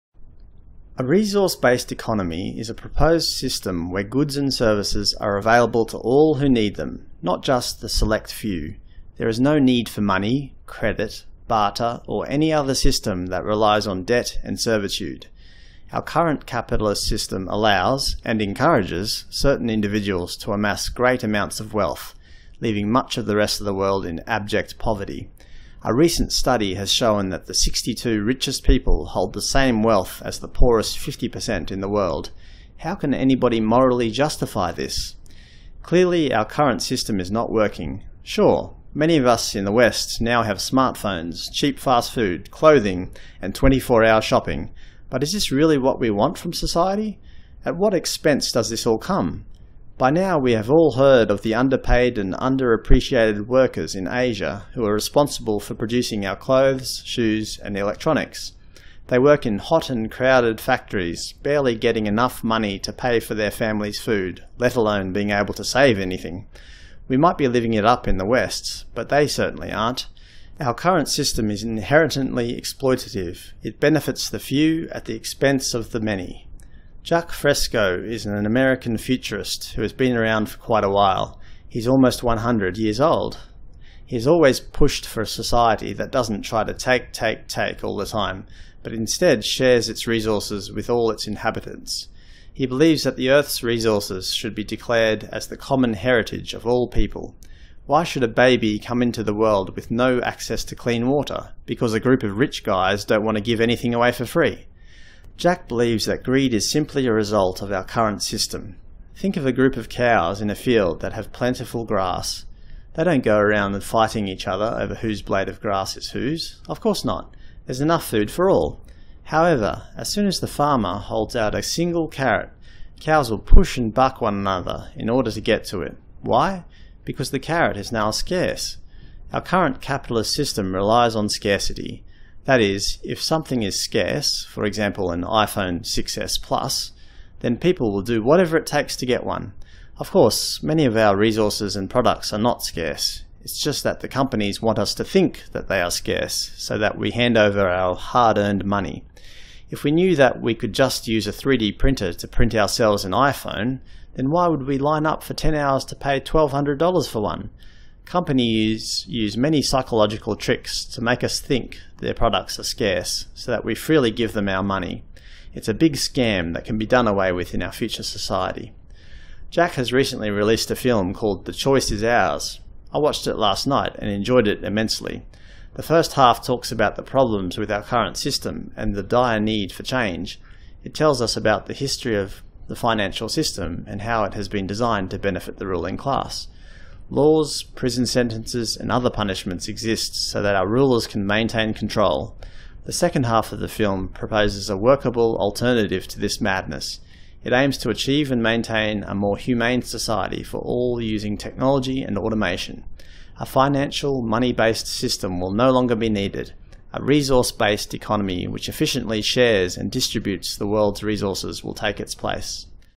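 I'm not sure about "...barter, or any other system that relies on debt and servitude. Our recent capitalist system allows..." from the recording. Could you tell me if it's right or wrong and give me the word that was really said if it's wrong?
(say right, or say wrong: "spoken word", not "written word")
wrong: "current", not "recent".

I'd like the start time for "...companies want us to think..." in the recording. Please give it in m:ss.
2:24.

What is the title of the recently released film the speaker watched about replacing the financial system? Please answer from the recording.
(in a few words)
The Choice Is Ours.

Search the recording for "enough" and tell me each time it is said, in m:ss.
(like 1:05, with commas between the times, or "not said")
1:02, 1:57.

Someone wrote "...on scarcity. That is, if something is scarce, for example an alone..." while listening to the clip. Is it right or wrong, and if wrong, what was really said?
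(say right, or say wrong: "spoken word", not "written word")
wrong: "iPhone", not "alone".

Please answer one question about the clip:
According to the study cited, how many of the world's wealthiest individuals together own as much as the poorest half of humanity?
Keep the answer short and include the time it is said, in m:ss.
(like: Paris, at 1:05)
62, at 0:27.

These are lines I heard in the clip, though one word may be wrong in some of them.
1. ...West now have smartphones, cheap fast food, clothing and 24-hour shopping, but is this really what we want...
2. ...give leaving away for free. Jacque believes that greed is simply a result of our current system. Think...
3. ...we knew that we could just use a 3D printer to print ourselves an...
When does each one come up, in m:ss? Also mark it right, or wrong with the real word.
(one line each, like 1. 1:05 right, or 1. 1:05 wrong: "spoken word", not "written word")
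1. 0:39 right
2. 1:43 wrong: "anything", not "leaving"
3. 2:29 right.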